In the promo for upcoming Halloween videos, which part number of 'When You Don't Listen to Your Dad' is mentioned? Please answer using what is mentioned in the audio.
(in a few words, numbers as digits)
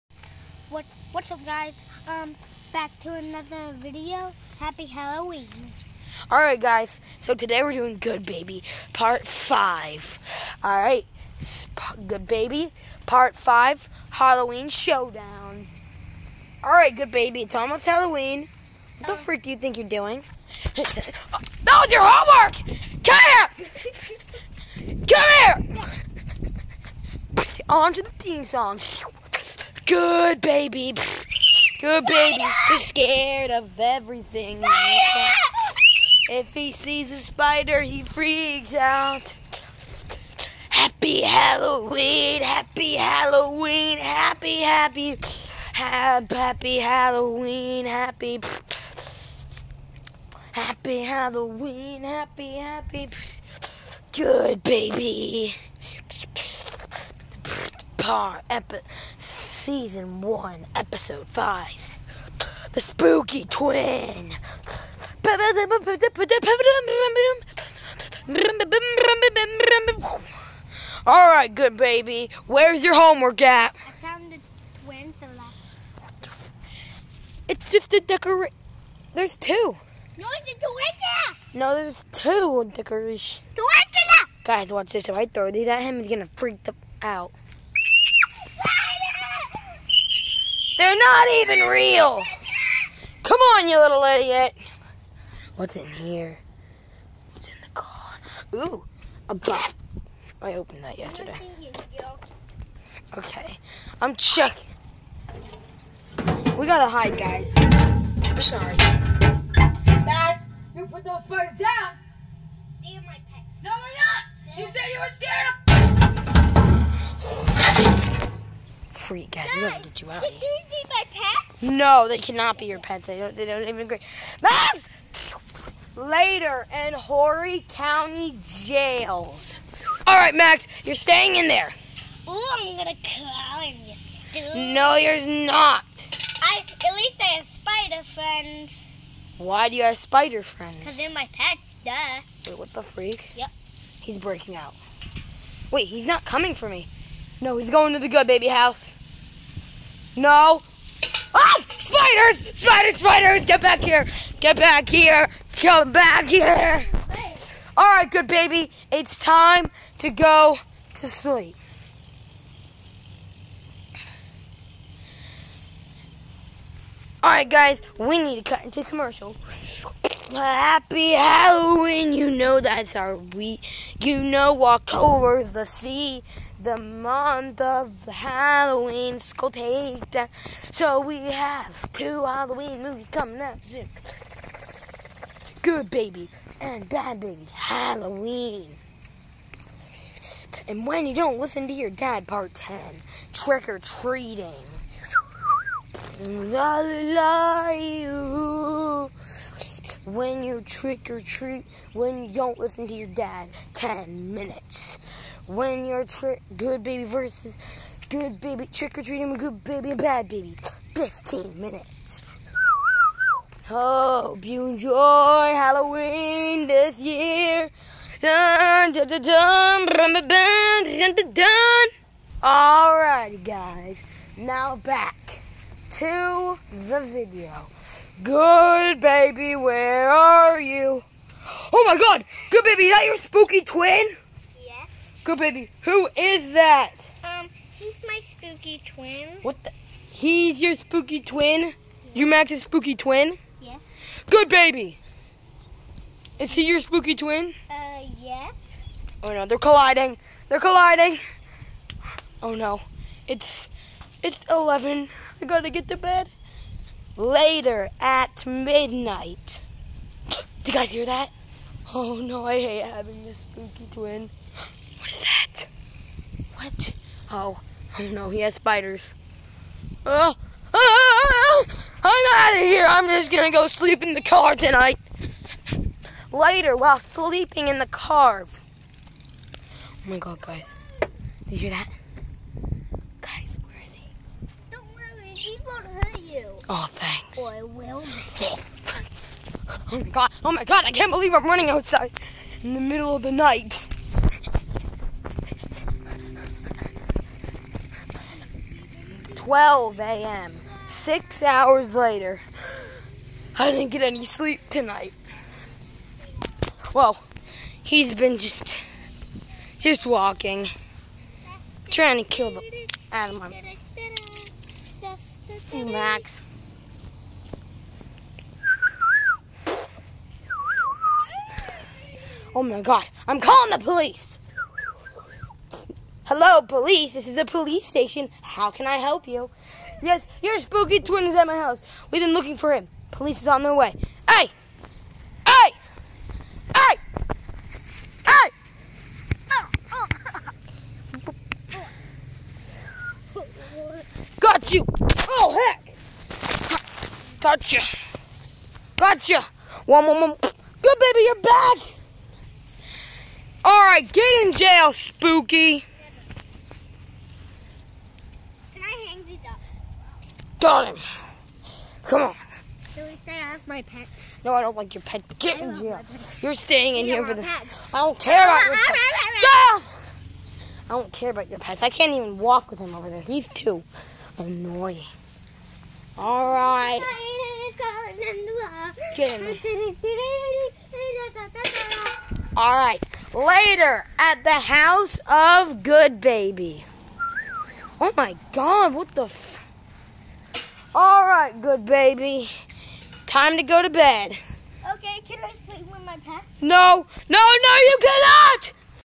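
Part 10.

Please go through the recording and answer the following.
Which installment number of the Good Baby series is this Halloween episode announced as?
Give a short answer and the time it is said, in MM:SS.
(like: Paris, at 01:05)
Part 5, at 00:12.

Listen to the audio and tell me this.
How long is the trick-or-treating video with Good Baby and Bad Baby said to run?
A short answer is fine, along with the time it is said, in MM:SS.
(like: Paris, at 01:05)
15 minutes, at 03:30.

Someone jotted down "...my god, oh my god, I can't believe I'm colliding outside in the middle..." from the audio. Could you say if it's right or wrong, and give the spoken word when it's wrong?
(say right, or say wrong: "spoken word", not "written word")
wrong: "running", not "colliding".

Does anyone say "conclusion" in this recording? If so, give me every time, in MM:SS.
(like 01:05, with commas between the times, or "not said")
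not said.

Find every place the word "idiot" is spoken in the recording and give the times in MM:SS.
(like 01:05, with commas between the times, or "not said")
01:34.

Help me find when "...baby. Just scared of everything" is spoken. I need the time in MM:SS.
00:32.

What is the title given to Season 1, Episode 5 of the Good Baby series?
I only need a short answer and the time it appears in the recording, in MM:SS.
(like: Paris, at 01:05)
The Spooky Twin, at 01:02.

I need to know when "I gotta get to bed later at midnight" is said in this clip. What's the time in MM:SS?
04:15.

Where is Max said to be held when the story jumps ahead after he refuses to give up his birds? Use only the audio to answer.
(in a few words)
Horry County jails.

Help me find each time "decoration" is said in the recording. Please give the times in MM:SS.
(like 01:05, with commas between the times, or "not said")
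01:17, 01:22.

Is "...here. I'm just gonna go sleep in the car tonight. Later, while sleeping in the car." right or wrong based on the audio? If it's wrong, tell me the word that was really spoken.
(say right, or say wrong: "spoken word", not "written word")
right.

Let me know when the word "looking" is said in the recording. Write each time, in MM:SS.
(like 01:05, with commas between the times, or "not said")
05:32.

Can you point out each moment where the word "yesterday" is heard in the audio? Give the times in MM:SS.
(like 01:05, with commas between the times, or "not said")
01:40.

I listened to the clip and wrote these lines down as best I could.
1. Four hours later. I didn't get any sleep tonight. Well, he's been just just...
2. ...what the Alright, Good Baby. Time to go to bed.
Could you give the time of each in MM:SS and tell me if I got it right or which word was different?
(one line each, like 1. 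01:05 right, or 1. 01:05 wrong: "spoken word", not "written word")
1. 05:00 wrong: "Six", not "Four"
2. 06:28 right.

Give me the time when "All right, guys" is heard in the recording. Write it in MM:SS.
02:47.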